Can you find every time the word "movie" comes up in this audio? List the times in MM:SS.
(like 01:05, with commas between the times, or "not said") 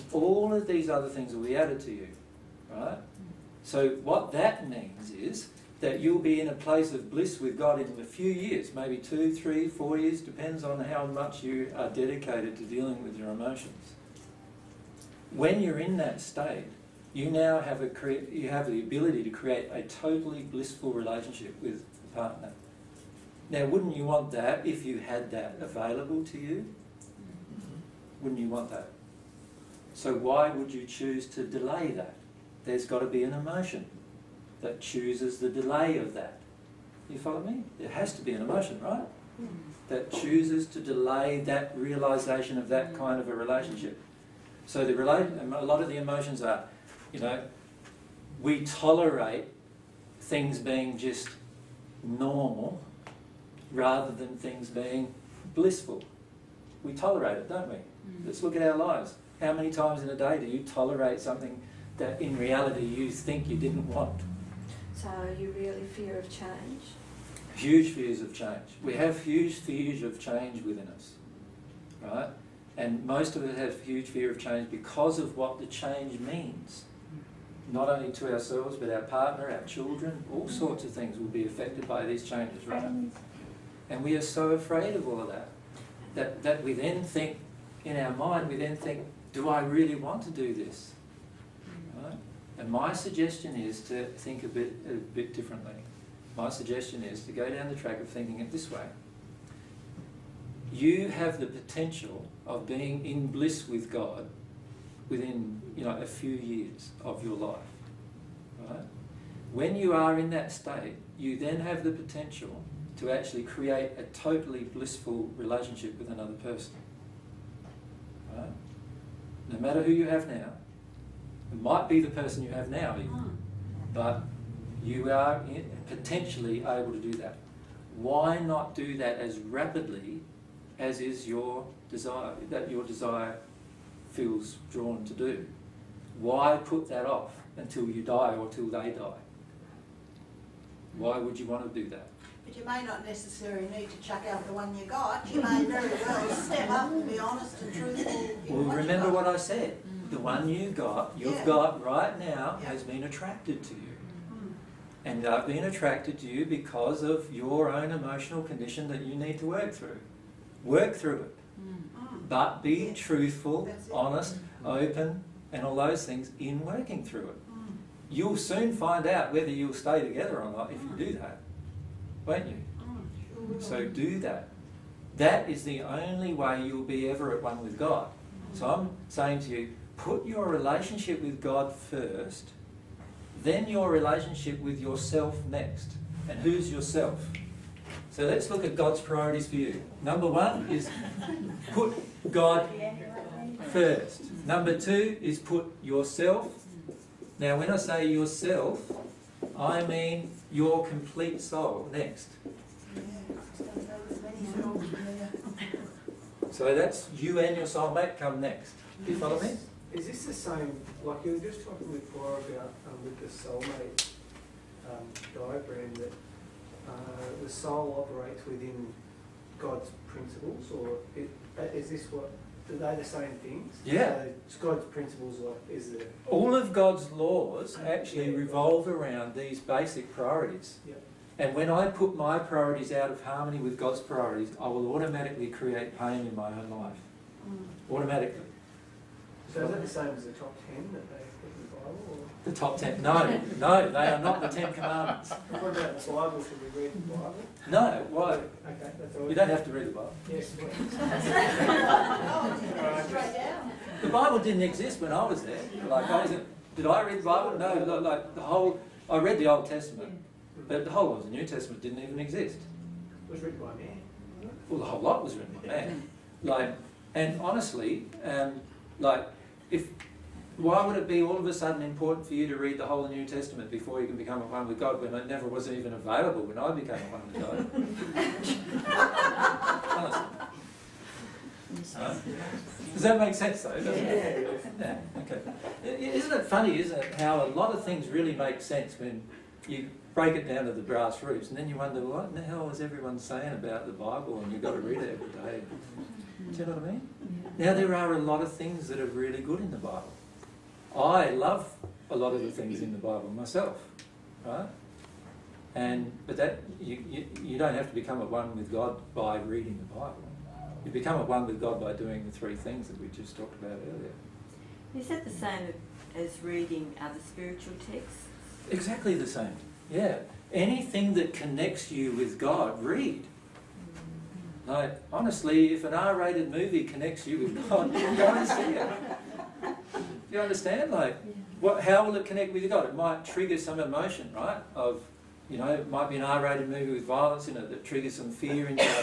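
05:26, 05:36.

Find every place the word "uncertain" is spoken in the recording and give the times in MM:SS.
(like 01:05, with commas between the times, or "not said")
not said.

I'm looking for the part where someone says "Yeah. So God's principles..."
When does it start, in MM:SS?
03:43.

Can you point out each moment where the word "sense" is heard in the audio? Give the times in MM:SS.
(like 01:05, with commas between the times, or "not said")
04:43, 04:48.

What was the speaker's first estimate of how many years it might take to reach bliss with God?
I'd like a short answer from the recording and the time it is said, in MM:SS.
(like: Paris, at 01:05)
2 to 4 years, at 00:08.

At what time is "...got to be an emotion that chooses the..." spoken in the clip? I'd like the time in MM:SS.
00:32.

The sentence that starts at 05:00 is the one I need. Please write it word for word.
I love a lot of the things in the Bible myself, right?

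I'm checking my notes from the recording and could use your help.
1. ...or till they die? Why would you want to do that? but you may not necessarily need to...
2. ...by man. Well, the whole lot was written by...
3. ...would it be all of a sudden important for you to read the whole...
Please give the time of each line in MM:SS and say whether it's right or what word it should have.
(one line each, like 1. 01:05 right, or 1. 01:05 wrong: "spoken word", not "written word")
1. 02:18 right
2. 04:23 right
3. 04:30 right.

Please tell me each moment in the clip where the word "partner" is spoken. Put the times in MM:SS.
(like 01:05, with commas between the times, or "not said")
00:22, 01:19.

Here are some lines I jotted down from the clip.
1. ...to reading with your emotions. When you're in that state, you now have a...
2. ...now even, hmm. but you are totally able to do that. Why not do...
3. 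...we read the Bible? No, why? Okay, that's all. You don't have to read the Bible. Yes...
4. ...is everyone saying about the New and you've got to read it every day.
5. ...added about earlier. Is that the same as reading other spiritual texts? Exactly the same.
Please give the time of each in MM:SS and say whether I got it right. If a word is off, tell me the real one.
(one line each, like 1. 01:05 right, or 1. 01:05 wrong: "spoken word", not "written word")
1. 00:12 wrong: "dealing", not "reading"
2. 02:02 wrong: "potentially", not "totally"
3. 04:06 right
4. 04:52 wrong: "Bible", not "New"
5. 05:13 wrong: "talked", not "added".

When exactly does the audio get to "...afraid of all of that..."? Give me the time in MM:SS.
01:24.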